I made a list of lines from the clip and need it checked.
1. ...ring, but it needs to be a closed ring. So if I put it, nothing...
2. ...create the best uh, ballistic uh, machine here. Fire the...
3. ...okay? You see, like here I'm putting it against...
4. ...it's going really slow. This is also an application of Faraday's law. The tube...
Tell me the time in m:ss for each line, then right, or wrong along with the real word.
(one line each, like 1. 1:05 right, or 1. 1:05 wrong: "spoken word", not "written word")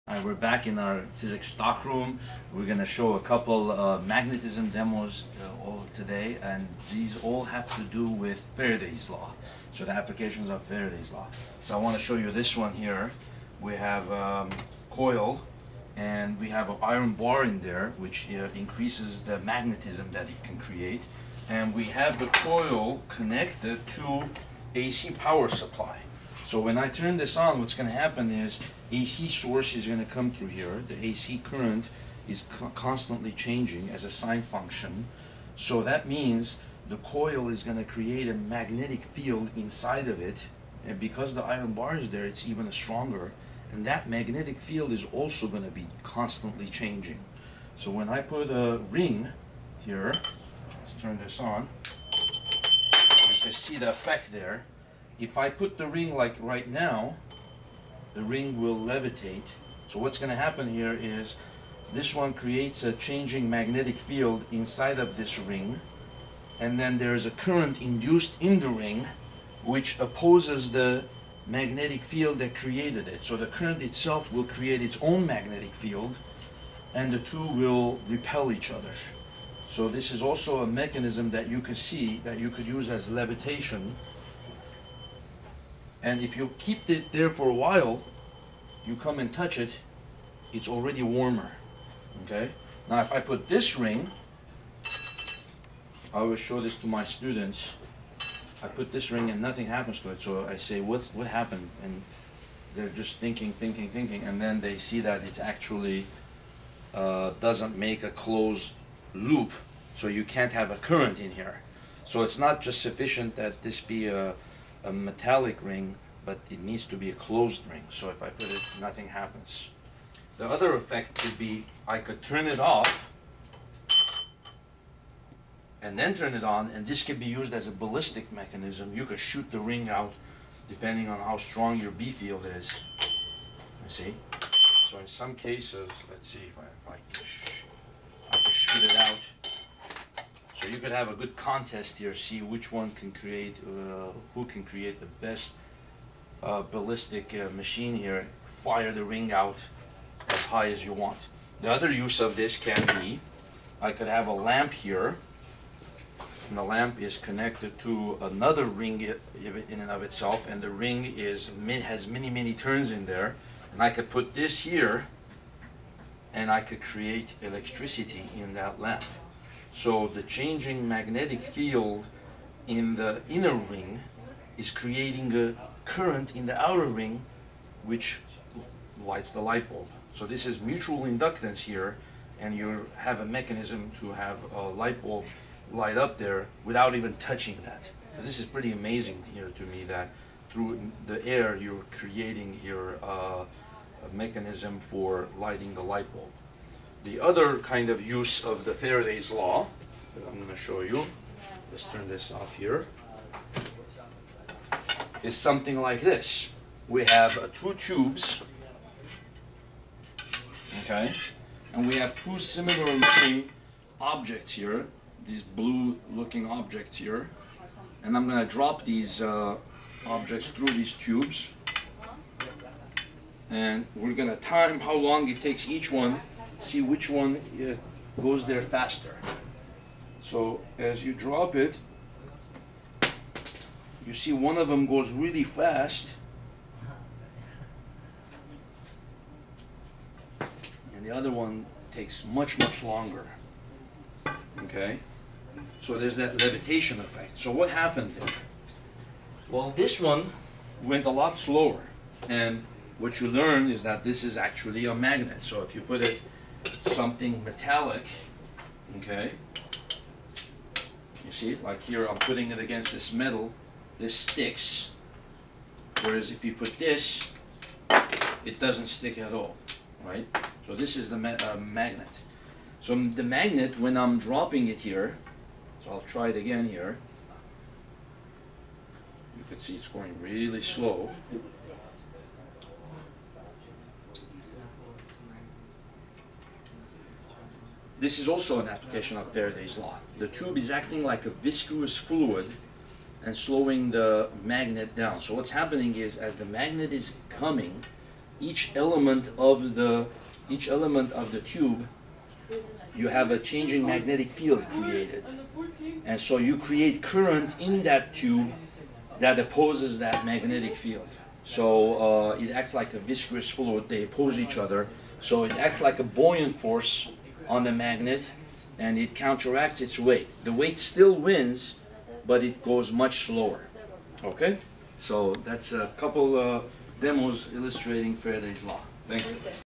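1. 1:55 right
2. 2:24 right
3. 4:18 right
4. 4:39 right.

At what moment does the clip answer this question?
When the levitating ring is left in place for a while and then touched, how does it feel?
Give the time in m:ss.
1:31.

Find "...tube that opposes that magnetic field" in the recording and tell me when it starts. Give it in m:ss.
5:08.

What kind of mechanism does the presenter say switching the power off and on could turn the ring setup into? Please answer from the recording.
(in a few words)
Ballistic mechanism.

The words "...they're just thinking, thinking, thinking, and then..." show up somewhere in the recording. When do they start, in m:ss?
1:42.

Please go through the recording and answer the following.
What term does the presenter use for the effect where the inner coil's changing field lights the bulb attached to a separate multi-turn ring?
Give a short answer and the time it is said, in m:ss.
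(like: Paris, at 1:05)
Mutual inductance, at 3:00.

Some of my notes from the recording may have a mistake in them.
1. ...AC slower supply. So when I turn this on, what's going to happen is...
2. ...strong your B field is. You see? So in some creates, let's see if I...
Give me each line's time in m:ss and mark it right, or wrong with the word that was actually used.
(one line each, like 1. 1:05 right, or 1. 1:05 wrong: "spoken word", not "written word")
1. 0:24 wrong: "power", not "slower"
2. 2:11 wrong: "cases", not "creates".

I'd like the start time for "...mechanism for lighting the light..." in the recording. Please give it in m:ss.
3:14.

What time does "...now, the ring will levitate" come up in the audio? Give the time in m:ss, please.
0:56.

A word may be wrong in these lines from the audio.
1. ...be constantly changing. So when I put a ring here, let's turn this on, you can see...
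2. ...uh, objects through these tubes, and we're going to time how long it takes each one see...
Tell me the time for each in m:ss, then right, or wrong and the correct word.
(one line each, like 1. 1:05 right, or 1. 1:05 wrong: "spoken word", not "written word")
1. 0:45 right
2. 3:39 right.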